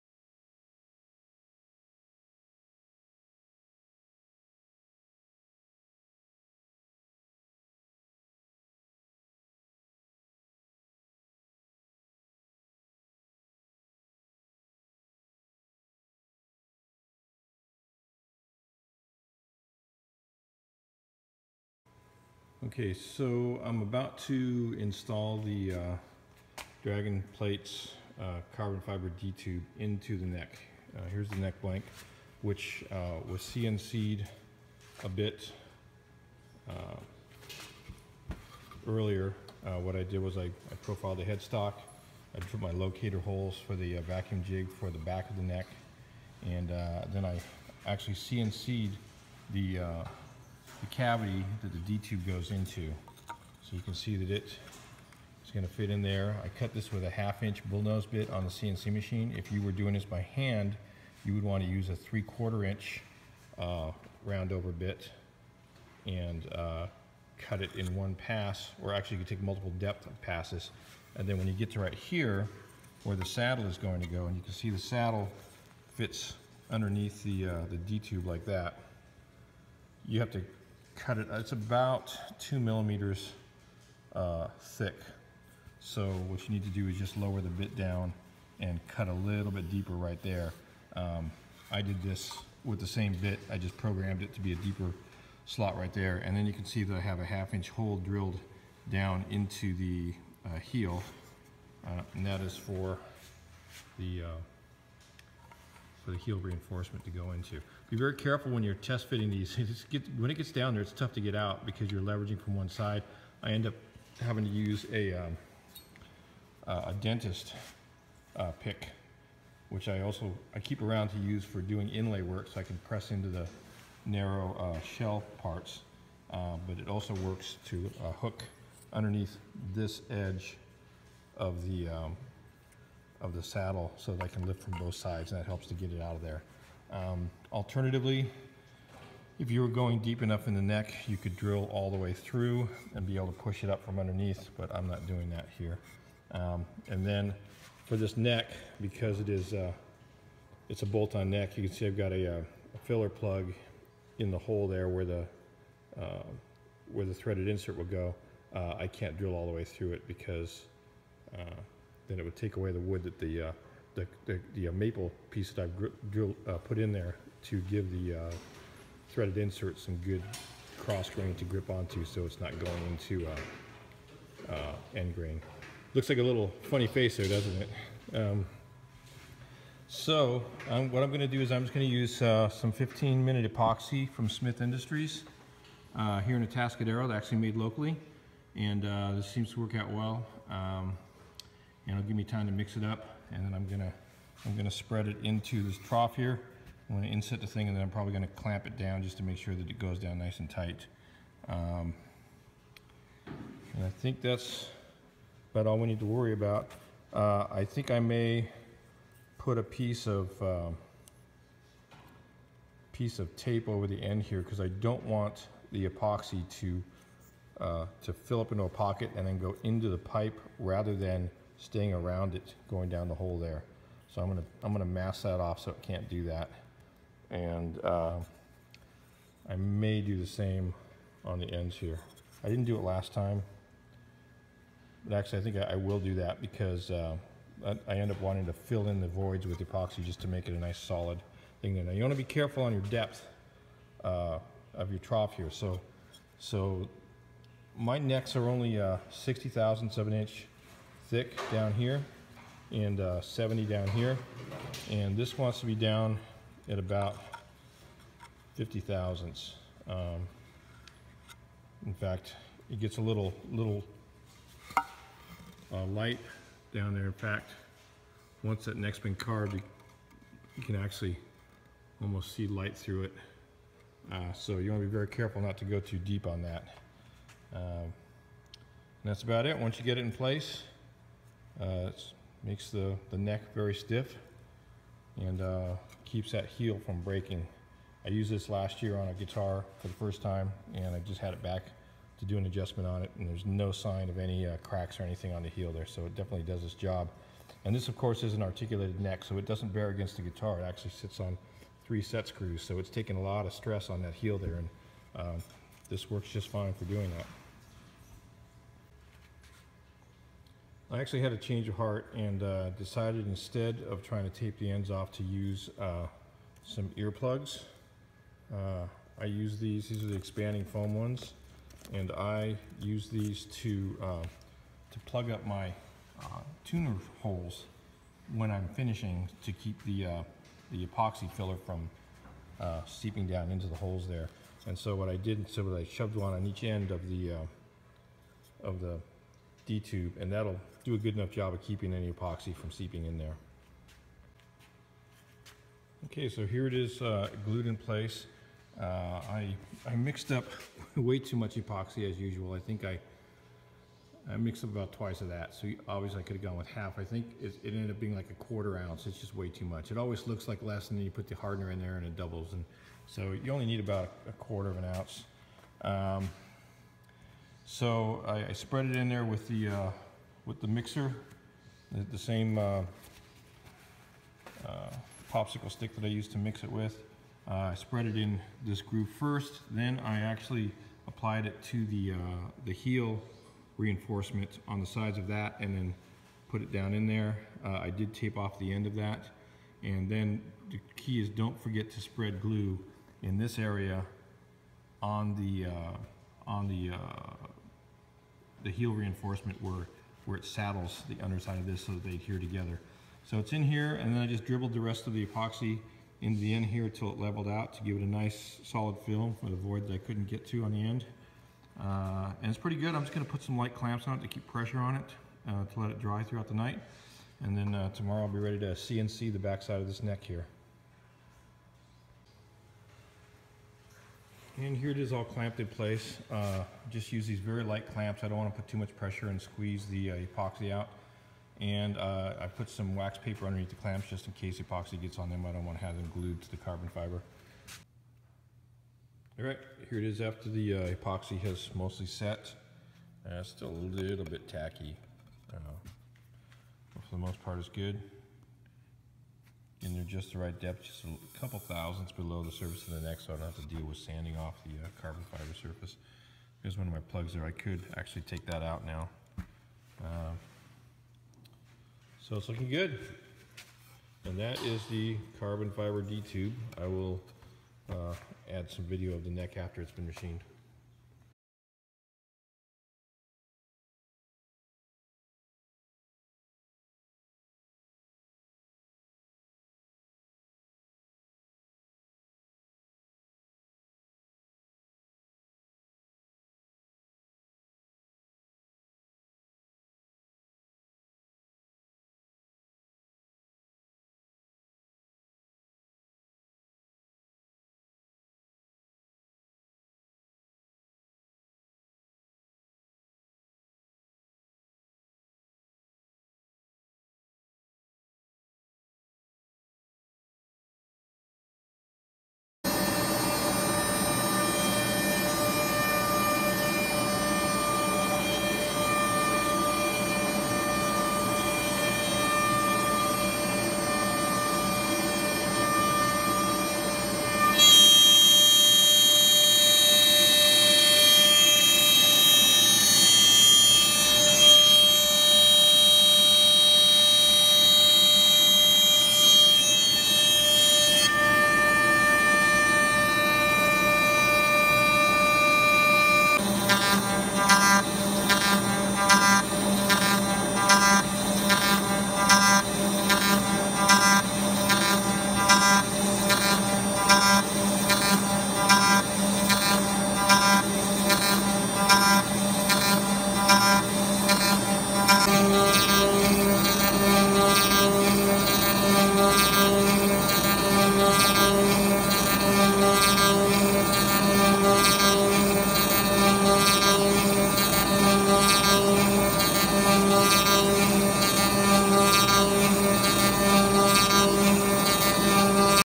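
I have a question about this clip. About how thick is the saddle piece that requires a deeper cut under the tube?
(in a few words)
2 millimeters.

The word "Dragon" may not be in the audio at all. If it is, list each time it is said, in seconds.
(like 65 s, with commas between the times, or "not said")
26 s.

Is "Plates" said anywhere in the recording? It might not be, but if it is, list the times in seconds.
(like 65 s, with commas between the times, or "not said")
27 s.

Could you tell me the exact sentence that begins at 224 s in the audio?
So I'm gonna I'm gonna mask that off so it can't do that.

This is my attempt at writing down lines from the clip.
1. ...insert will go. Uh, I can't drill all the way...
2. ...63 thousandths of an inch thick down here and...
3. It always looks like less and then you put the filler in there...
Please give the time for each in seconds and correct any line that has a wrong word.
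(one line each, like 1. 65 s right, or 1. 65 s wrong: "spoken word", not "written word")
1. 157 s right
2. 249 s wrong: "60", not "63"
3. 359 s wrong: "hardener", not "filler".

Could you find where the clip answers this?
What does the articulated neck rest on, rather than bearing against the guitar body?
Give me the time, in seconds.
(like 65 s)
301 s.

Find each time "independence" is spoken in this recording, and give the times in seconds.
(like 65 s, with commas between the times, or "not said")
not said.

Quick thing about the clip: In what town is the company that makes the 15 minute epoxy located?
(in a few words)
Atascadero.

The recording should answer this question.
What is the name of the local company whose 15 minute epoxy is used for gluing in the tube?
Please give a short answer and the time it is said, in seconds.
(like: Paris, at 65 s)
Smith Industries, at 184 s.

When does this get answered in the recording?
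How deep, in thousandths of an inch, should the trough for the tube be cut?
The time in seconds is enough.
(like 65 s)
258 s.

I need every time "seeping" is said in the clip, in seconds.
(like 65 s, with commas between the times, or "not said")
332 s, 342 s.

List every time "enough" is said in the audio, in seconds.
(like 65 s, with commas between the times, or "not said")
140 s, 341 s.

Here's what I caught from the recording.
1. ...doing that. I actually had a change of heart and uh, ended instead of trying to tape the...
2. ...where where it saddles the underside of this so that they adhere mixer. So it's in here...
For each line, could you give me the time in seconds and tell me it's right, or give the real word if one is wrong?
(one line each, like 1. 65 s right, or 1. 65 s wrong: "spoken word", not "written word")
1. 306 s wrong: "decided", not "ended"
2. 399 s wrong: "together", not "mixer".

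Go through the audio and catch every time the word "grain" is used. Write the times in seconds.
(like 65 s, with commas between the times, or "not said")
171 s, 175 s.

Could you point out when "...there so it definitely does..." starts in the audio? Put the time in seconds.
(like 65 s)
295 s.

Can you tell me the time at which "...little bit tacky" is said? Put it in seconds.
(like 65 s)
443 s.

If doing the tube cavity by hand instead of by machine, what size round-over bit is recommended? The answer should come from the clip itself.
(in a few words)
3/4 inch.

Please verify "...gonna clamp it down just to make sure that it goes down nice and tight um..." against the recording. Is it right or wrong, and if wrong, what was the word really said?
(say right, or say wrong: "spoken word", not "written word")
right.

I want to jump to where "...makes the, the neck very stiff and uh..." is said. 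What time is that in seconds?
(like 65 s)
282 s.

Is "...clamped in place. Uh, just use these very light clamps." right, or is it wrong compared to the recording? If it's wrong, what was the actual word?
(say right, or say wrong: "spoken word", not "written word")
right.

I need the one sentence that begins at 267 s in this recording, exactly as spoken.
In fact, once that neck's been carved, you, you can actually almost see light through it.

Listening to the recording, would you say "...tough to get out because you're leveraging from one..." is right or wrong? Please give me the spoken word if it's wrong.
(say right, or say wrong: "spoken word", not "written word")
right.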